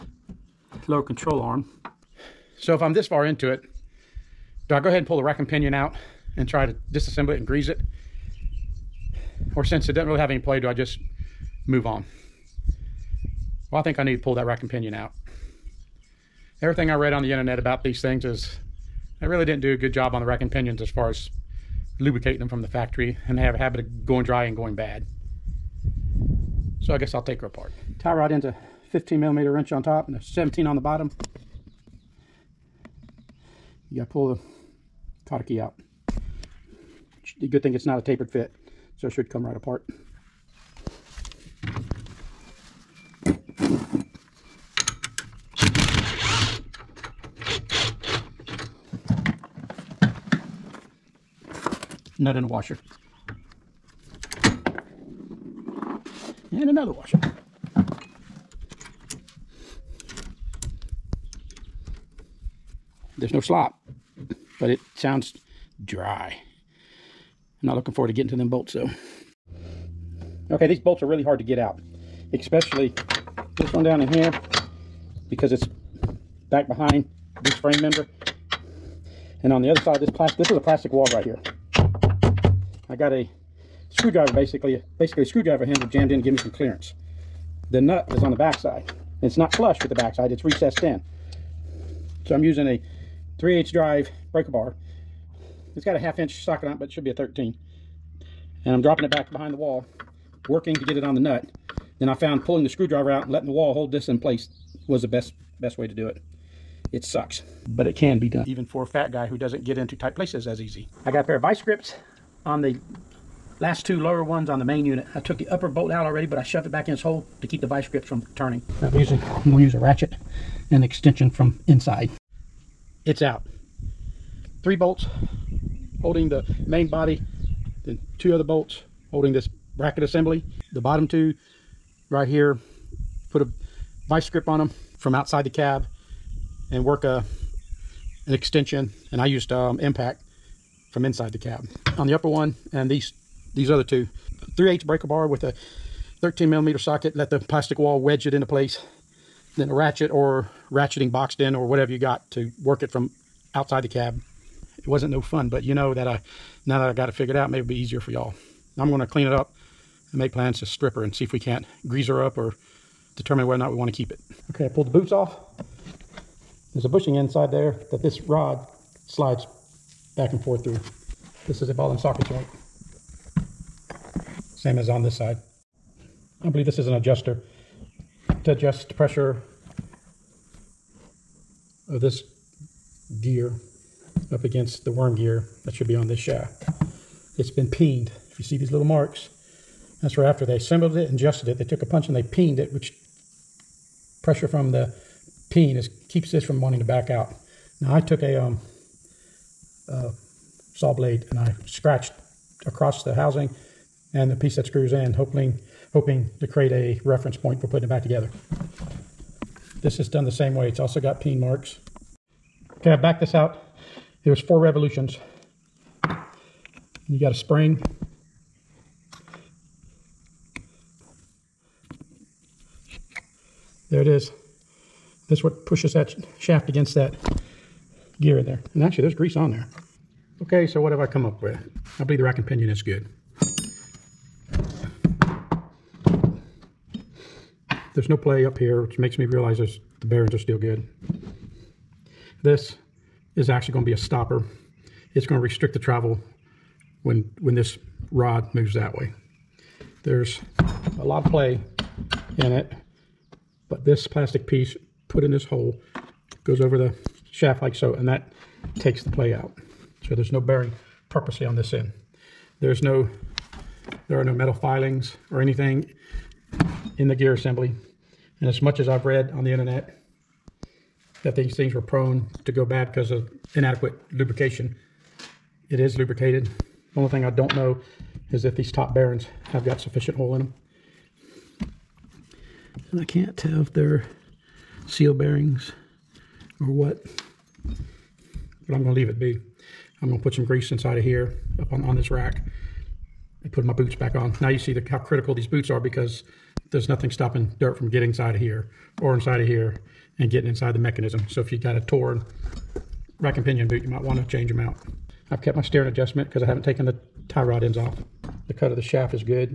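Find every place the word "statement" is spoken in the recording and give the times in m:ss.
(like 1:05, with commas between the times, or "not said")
not said.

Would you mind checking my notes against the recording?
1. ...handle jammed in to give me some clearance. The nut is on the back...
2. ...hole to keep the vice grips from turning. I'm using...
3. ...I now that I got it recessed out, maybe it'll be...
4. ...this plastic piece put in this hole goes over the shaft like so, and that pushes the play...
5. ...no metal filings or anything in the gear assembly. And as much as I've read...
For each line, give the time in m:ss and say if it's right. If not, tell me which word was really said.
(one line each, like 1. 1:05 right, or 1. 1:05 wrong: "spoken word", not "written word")
1. 1:25 right
2. 1:57 right
3. 2:36 wrong: "figured", not "recessed"
4. 4:13 wrong: "takes", not "pushes"
5. 4:24 right.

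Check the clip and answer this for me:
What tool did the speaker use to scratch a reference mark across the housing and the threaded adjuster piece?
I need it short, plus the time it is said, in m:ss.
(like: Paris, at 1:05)
saw blade, at 3:20.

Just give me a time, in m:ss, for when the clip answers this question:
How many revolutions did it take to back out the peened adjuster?
3:34.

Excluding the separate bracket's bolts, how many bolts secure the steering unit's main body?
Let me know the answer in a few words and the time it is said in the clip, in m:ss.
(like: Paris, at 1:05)
3, at 2:04.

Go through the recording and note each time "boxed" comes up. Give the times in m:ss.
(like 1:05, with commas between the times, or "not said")
2:31.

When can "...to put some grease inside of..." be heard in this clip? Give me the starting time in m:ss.
4:50.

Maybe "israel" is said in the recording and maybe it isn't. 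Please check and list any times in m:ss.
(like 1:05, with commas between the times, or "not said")
not said.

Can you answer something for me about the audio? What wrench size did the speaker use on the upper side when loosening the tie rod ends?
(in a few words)
15 millimeter.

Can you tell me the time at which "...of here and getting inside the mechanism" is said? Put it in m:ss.
4:59.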